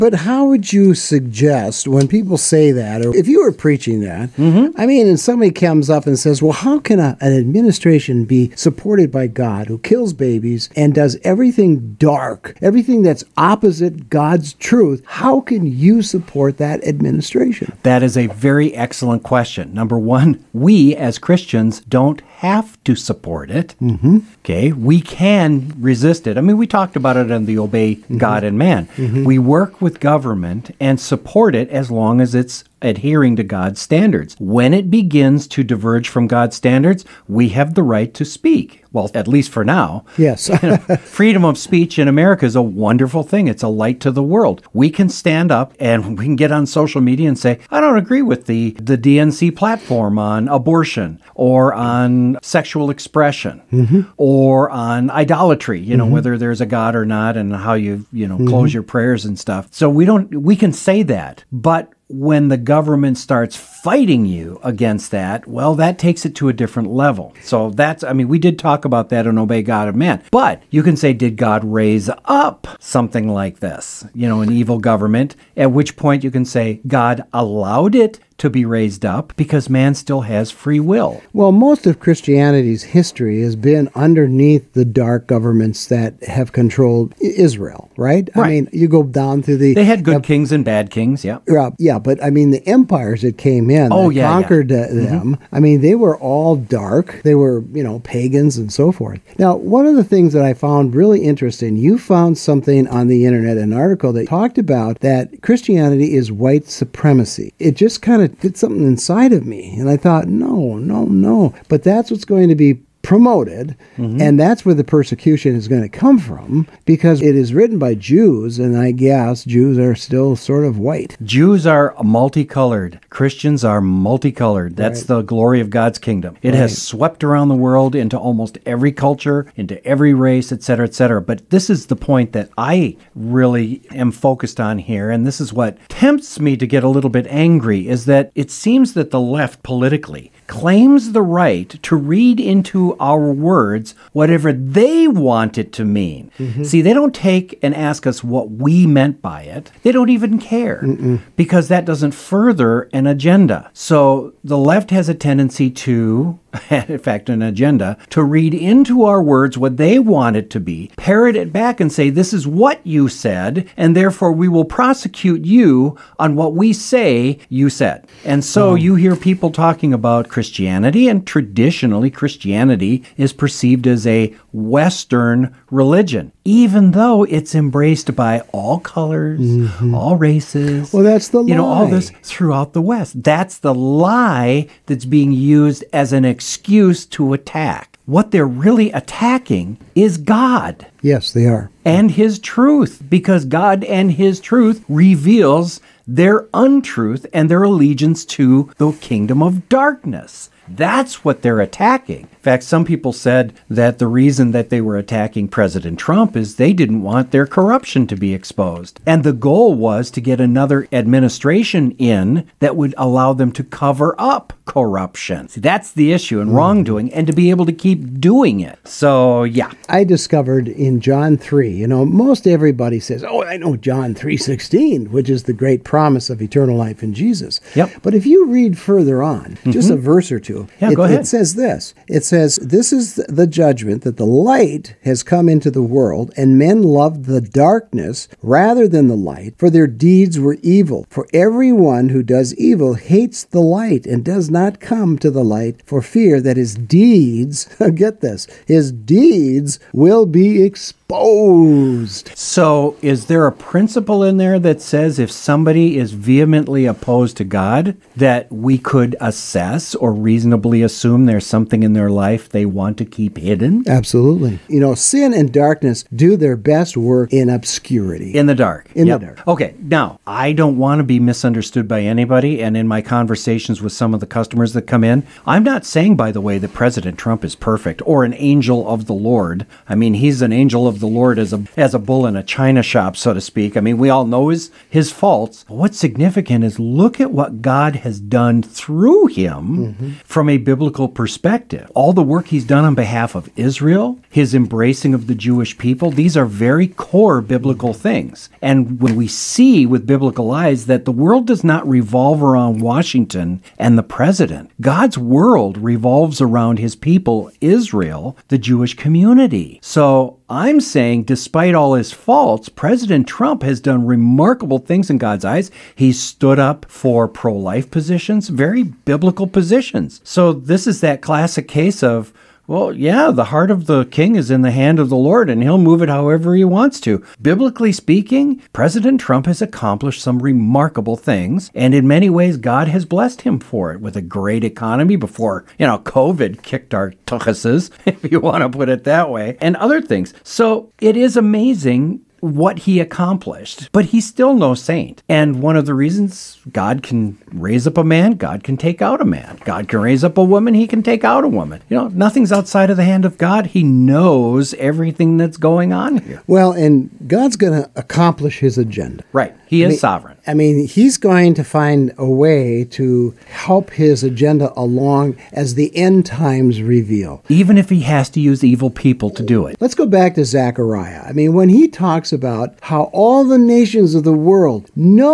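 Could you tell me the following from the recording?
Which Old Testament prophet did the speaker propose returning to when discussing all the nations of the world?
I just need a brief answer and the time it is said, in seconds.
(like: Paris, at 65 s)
Zechariah, at 370 s.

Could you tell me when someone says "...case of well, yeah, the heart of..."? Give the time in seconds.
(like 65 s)
321 s.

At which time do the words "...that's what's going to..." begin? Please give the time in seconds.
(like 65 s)
111 s.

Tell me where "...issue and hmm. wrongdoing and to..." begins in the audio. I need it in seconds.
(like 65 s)
216 s.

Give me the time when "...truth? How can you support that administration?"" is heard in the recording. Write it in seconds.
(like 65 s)
14 s.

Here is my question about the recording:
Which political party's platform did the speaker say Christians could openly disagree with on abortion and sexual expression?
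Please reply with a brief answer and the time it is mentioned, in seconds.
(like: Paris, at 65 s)
DNC, at 48 s.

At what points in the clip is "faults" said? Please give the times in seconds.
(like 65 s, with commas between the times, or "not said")
285 s, 312 s.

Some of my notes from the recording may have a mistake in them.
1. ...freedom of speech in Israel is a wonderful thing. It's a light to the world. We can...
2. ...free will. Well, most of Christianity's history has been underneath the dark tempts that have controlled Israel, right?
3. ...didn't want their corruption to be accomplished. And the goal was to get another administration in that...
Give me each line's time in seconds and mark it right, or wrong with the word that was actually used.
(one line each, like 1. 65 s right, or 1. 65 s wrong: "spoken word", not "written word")
1. 40 s wrong: "America", not "Israel"
2. 80 s wrong: "governments", not "tempts"
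3. 206 s wrong: "exposed", not "accomplished".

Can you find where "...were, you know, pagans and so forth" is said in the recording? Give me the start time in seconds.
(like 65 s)
97 s.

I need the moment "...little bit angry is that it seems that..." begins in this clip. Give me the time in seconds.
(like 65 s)
136 s.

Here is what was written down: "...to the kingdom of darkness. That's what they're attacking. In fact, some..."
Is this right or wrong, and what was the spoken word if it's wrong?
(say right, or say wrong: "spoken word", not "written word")
right.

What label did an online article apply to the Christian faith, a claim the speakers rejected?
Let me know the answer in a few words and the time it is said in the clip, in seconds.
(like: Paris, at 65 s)
White supremacy, at 106 s.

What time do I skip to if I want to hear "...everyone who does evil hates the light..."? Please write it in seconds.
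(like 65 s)
241 s.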